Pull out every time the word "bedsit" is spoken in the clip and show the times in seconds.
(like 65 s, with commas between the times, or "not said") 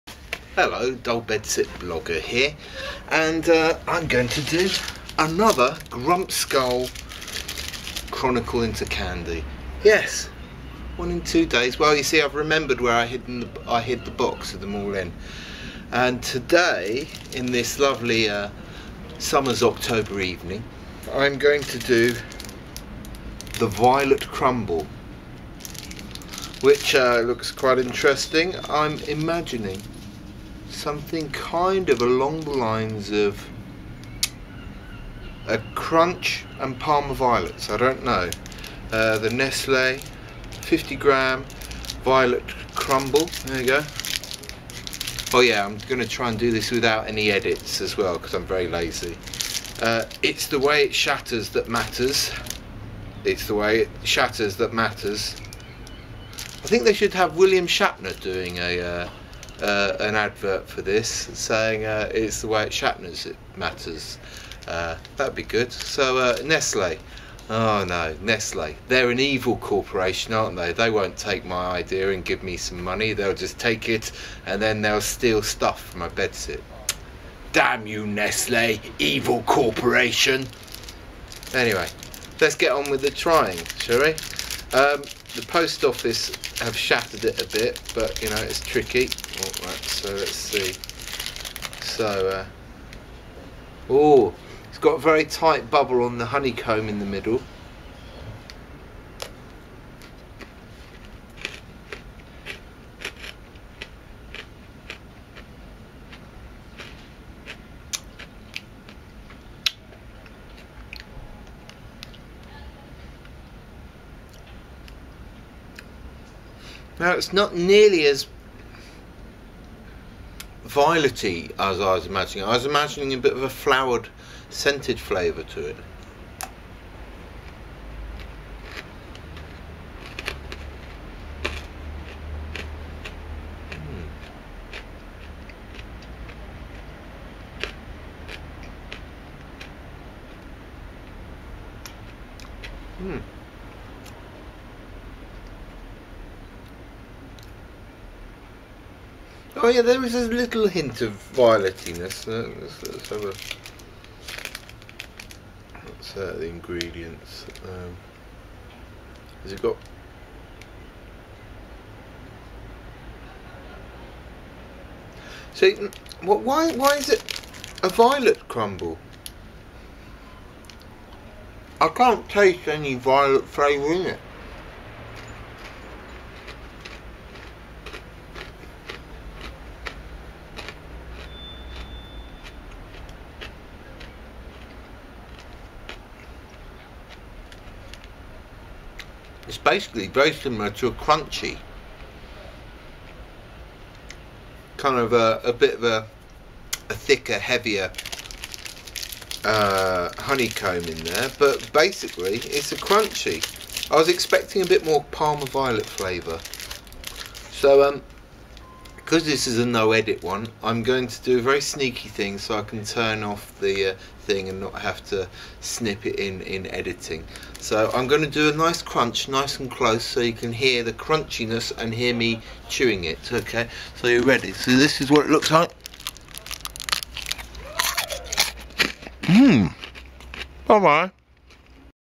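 1 s, 76 s.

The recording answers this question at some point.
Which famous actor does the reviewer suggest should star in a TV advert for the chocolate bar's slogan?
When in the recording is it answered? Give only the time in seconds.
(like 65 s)
57 s.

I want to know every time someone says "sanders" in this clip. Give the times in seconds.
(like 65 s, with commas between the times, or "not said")
not said.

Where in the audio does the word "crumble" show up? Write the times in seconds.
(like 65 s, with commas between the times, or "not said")
24 s, 42 s, 168 s.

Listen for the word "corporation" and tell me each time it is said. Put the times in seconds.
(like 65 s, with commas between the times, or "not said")
69 s, 79 s.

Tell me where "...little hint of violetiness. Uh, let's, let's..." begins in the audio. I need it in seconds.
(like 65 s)
150 s.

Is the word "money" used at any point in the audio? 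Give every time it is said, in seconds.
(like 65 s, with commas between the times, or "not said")
72 s.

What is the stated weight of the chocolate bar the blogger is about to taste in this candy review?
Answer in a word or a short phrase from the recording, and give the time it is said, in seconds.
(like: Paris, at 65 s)
50 grams, at 40 s.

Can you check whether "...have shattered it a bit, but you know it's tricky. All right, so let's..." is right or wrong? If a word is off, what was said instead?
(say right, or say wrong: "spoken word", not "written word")
right.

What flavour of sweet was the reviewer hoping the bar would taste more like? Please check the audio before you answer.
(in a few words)
Parma Violet.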